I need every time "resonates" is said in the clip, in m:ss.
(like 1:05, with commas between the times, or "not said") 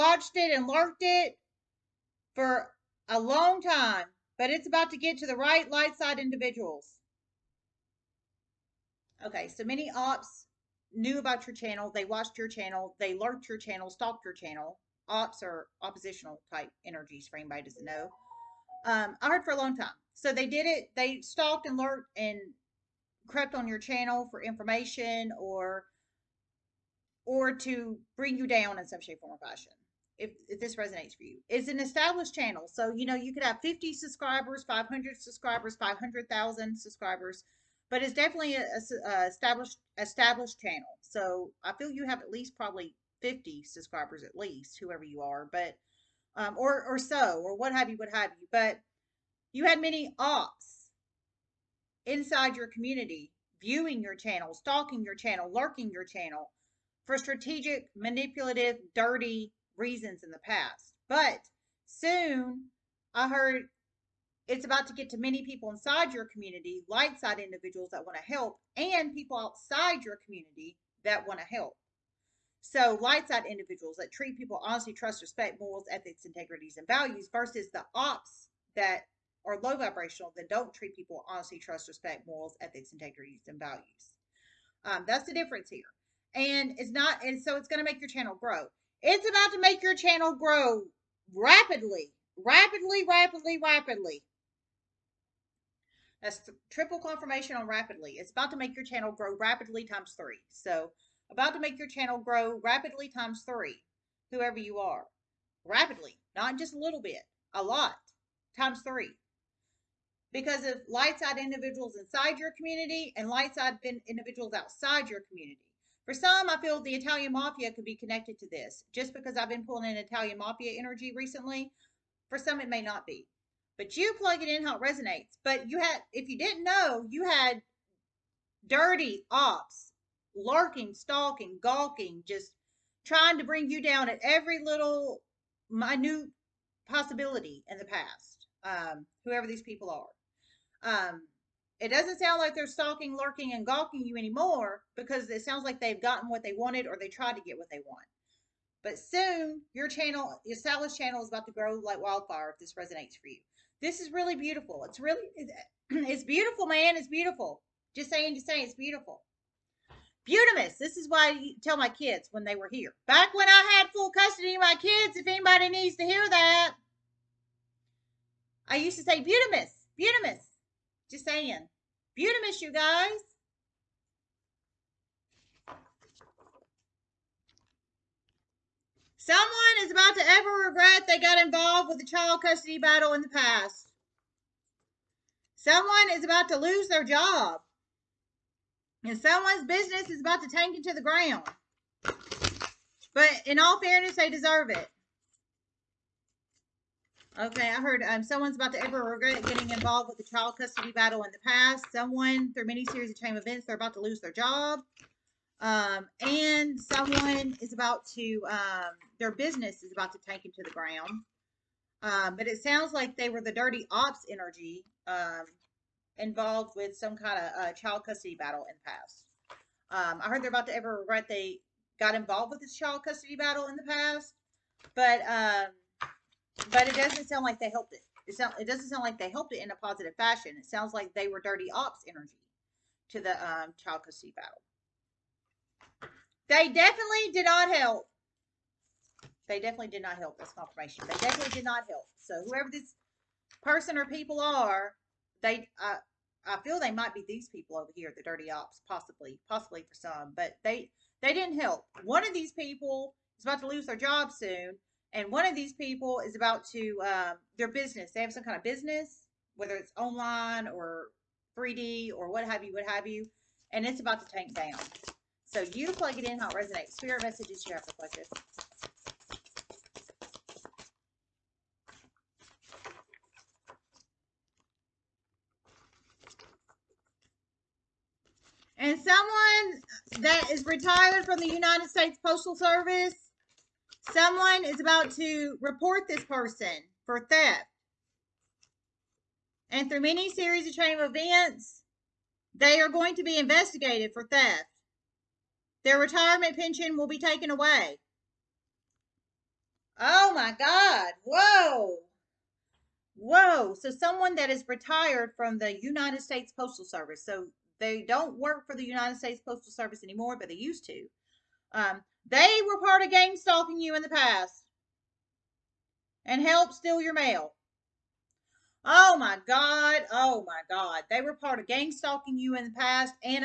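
0:30, 2:04, 2:32, 4:26.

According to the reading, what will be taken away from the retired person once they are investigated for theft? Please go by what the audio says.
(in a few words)
Retirement pension.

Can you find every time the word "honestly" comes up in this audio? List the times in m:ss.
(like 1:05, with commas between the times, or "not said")
1:14, 1:21.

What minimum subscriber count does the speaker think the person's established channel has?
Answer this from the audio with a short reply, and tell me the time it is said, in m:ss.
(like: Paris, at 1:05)
50, at 0:42.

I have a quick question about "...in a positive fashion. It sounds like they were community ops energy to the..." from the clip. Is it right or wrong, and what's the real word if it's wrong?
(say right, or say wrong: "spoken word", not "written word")
wrong: "dirty", not "community".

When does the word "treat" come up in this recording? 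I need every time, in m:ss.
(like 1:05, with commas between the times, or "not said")
1:14, 1:20.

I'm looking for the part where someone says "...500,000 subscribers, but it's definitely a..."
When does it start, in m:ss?
0:35.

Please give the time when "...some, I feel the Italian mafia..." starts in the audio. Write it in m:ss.
1:56.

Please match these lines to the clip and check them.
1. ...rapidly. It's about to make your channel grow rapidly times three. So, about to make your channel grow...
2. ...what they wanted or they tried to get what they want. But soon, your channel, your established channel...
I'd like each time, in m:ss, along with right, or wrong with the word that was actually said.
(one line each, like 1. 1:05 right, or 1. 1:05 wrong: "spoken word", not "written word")
1. 1:37 right
2. 2:26 right.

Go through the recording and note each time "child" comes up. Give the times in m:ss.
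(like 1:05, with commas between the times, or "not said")
3:02, 3:20, 3:37, 3:42, 3:53.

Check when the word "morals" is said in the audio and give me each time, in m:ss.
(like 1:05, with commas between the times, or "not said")
1:15, 1:22.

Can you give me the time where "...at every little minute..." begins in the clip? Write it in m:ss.
2:14.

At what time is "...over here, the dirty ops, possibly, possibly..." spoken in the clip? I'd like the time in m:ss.
4:07.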